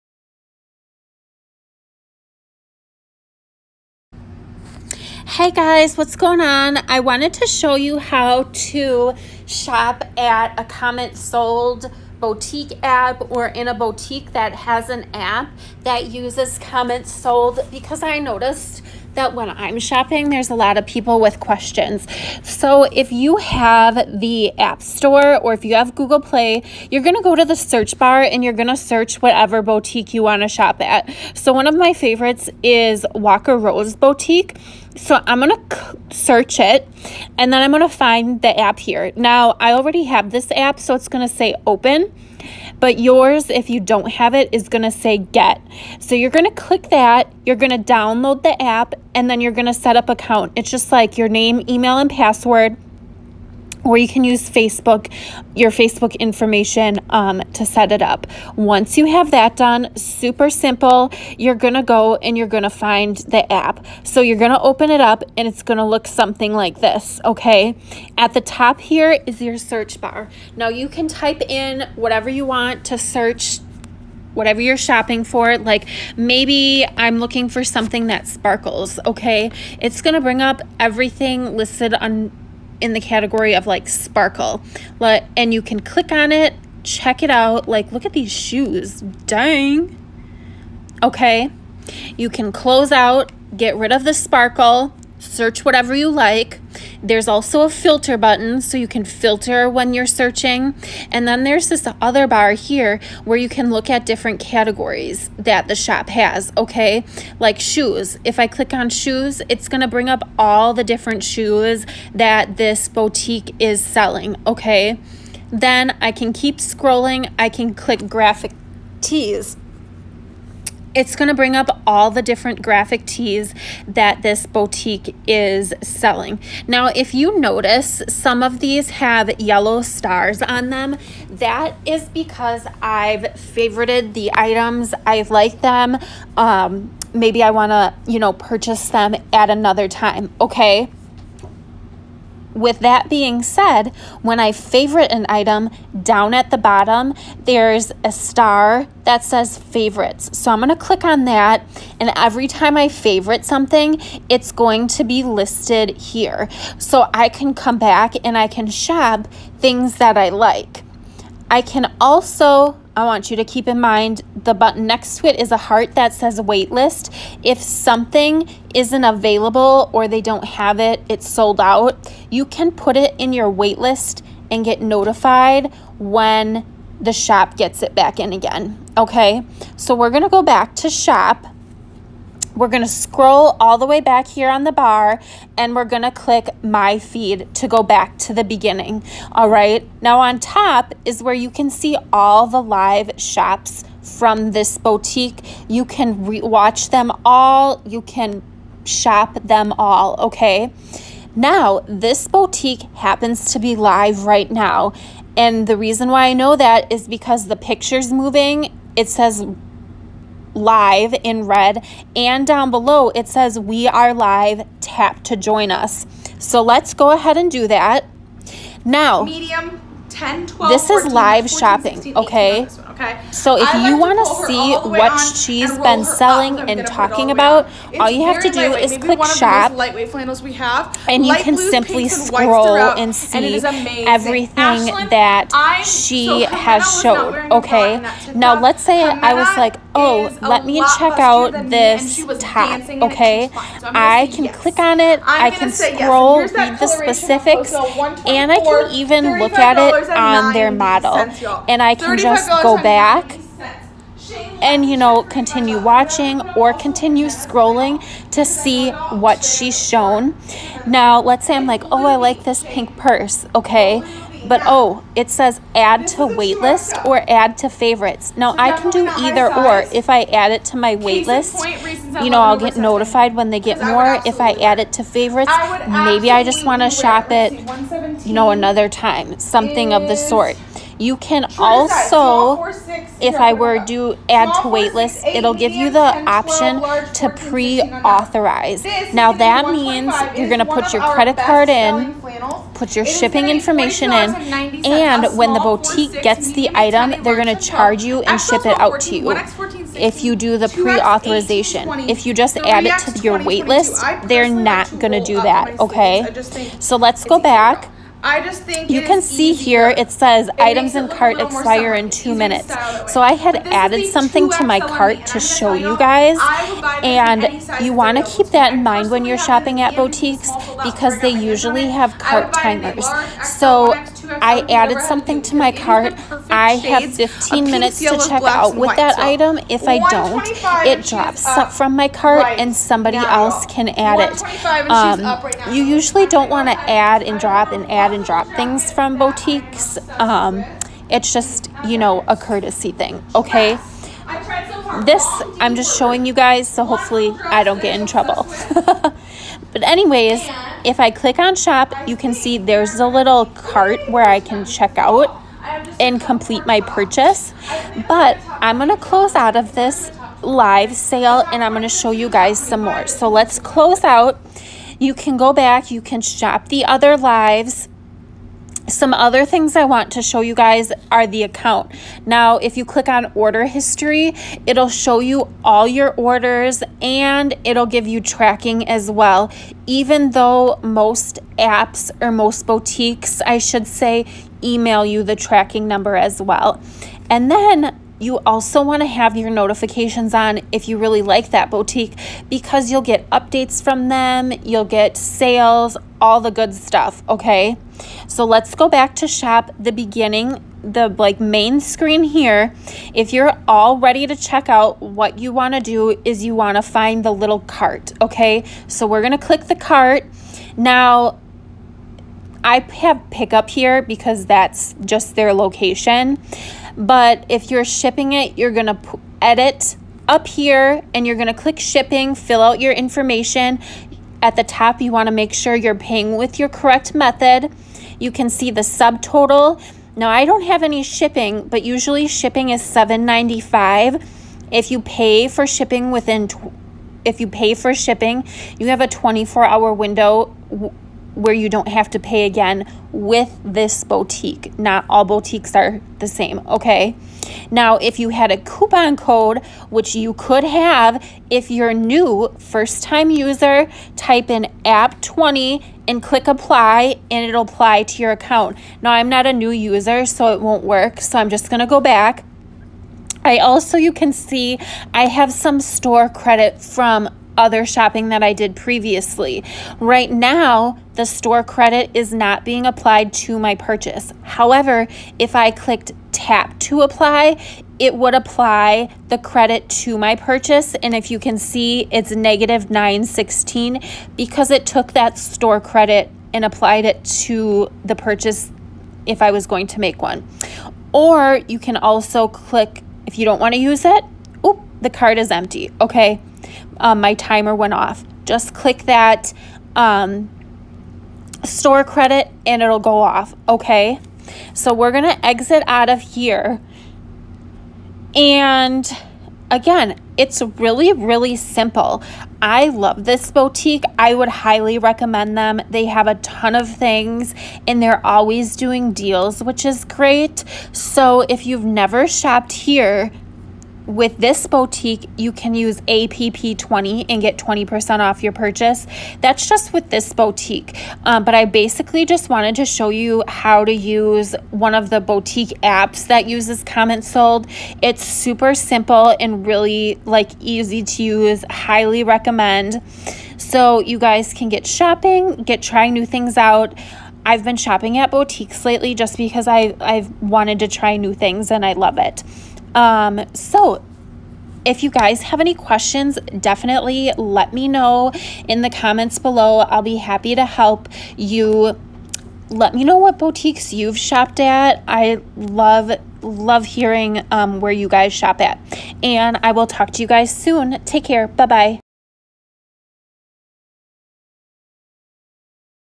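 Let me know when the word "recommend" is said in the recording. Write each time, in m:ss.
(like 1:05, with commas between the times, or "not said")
8:34, 9:02.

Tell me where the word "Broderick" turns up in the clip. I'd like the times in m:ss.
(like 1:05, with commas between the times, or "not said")
not said.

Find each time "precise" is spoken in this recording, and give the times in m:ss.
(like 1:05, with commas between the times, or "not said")
not said.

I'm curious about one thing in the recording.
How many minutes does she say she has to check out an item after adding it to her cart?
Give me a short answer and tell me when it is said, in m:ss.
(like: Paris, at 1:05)
15 minutes, at 5:27.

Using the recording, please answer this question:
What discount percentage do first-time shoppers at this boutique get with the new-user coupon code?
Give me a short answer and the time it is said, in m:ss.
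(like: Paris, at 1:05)
20%, at 8:47.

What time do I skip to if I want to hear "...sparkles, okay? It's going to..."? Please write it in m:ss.
1:18.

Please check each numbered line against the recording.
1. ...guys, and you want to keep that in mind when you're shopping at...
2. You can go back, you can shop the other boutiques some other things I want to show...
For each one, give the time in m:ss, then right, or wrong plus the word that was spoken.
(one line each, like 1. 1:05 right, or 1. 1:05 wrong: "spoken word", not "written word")
1. 5:15 right
2. 6:04 wrong: "lives", not "boutiques".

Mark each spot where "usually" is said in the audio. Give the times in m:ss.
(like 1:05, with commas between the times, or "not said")
5:21, 5:35, 7:11.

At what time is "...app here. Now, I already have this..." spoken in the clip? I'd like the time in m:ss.
0:38.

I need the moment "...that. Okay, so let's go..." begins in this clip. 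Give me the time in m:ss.
5:05.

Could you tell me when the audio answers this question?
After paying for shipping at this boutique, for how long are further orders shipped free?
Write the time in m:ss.
7:19.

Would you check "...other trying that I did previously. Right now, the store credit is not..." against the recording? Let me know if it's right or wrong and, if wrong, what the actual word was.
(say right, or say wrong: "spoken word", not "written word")
wrong: "shopping", not "trying".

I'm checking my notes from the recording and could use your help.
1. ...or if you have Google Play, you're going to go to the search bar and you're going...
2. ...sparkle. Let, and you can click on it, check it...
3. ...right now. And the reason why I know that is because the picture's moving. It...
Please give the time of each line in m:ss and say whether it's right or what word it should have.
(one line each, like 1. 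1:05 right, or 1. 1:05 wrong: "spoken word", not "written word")
1. 0:25 right
2. 1:23 right
3. 3:24 right.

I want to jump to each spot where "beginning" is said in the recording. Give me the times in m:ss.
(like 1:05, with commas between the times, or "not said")
3:08, 6:39.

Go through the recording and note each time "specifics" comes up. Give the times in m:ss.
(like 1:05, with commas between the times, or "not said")
4:06.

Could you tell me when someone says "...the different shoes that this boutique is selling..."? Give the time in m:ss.
1:50.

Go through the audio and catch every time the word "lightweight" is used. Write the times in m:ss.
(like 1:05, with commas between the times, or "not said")
3:49.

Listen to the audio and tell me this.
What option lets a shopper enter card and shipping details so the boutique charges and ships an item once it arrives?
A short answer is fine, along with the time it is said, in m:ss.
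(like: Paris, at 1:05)
pre-authorize, at 4:47.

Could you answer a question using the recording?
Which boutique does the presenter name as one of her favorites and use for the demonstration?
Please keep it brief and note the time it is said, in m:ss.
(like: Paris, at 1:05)
Walker Rose Boutique, at 0:33.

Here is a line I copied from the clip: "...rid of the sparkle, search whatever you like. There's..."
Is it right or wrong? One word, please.
right.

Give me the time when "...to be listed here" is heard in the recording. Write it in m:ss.
2:34.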